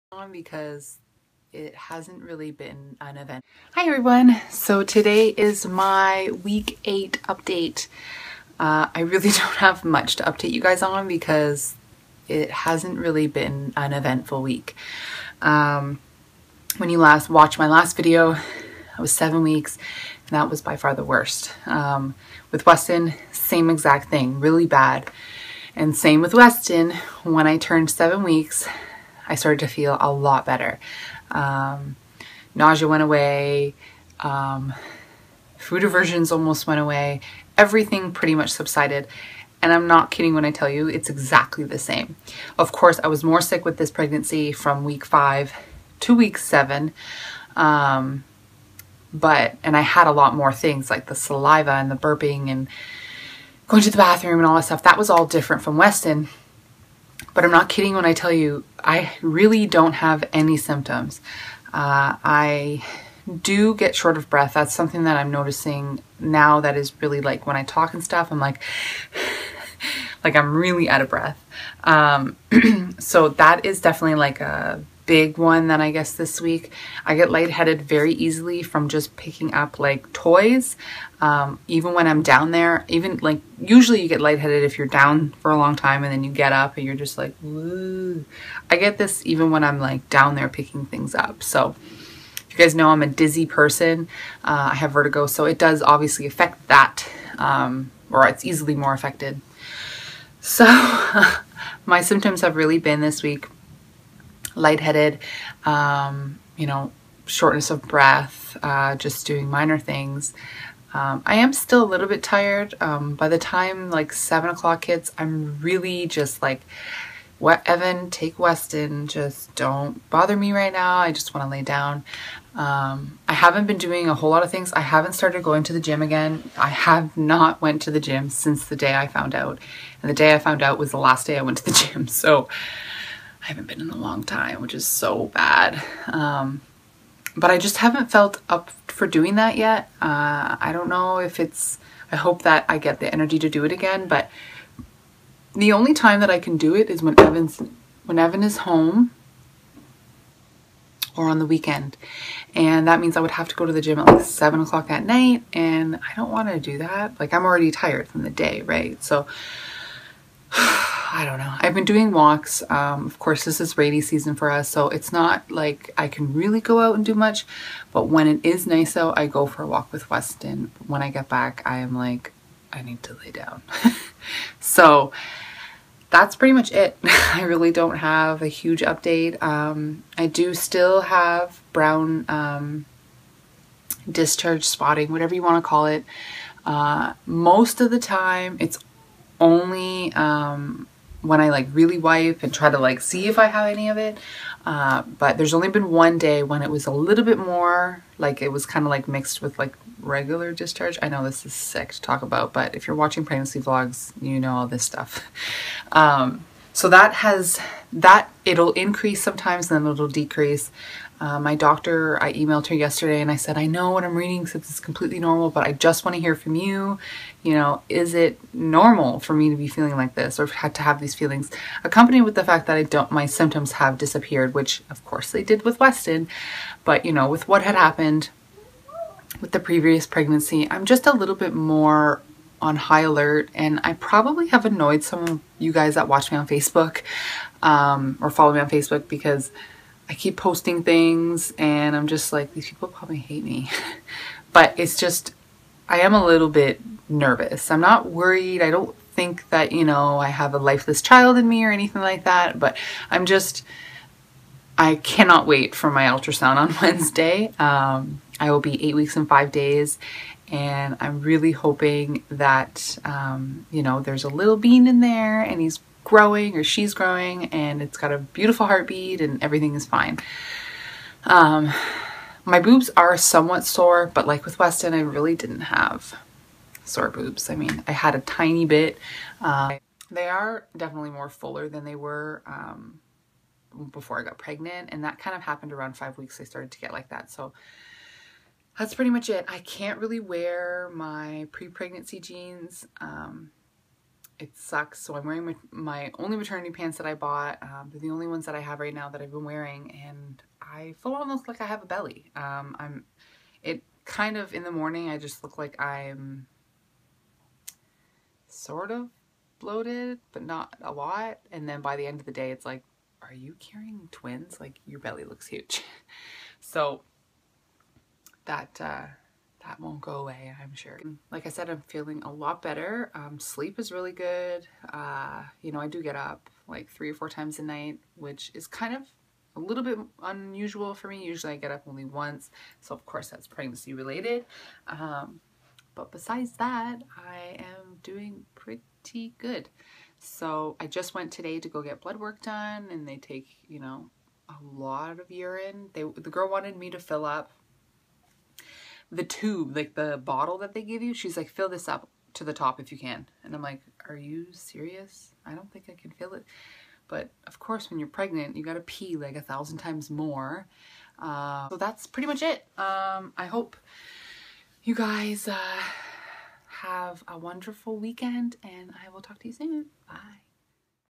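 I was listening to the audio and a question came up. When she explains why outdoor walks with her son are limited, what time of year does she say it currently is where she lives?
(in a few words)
rainy season.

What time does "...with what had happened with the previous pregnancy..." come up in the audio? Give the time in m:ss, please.
3:47.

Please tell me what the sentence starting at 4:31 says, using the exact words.
Um, my boobs are somewhat sore, but like with Weston, I really didn't have sore boobs.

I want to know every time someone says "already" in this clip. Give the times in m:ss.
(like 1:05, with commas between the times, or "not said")
2:37.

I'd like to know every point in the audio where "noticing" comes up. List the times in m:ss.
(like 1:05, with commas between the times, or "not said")
1:05.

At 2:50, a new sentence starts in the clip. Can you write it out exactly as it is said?
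When I get back, I am like, I need to lay down.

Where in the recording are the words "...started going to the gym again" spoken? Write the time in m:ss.
2:05.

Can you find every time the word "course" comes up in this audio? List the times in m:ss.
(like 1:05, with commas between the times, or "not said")
0:42, 2:43, 3:45, 5:33, 5:57.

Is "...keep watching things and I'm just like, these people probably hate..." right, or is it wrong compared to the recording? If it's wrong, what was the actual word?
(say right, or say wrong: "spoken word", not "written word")
wrong: "posting", not "watching".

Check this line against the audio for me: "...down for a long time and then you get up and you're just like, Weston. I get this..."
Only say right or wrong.
wrong.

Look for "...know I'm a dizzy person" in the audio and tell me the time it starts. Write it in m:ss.
1:32.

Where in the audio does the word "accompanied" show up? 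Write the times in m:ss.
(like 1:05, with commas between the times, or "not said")
3:41.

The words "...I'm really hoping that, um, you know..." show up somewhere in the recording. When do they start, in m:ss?
4:20.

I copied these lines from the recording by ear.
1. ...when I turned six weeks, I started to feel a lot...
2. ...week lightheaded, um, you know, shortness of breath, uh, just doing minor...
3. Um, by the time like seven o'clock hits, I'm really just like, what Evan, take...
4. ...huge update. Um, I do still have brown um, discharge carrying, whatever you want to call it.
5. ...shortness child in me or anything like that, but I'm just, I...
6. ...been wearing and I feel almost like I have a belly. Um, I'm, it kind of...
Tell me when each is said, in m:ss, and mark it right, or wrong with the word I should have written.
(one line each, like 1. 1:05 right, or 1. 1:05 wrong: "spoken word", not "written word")
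1. 0:27 wrong: "seven", not "six"
2. 1:43 right
3. 1:52 right
4. 2:58 wrong: "spotting", not "carrying"
5. 4:10 wrong: "lifeless", not "shortness"
6. 4:59 right.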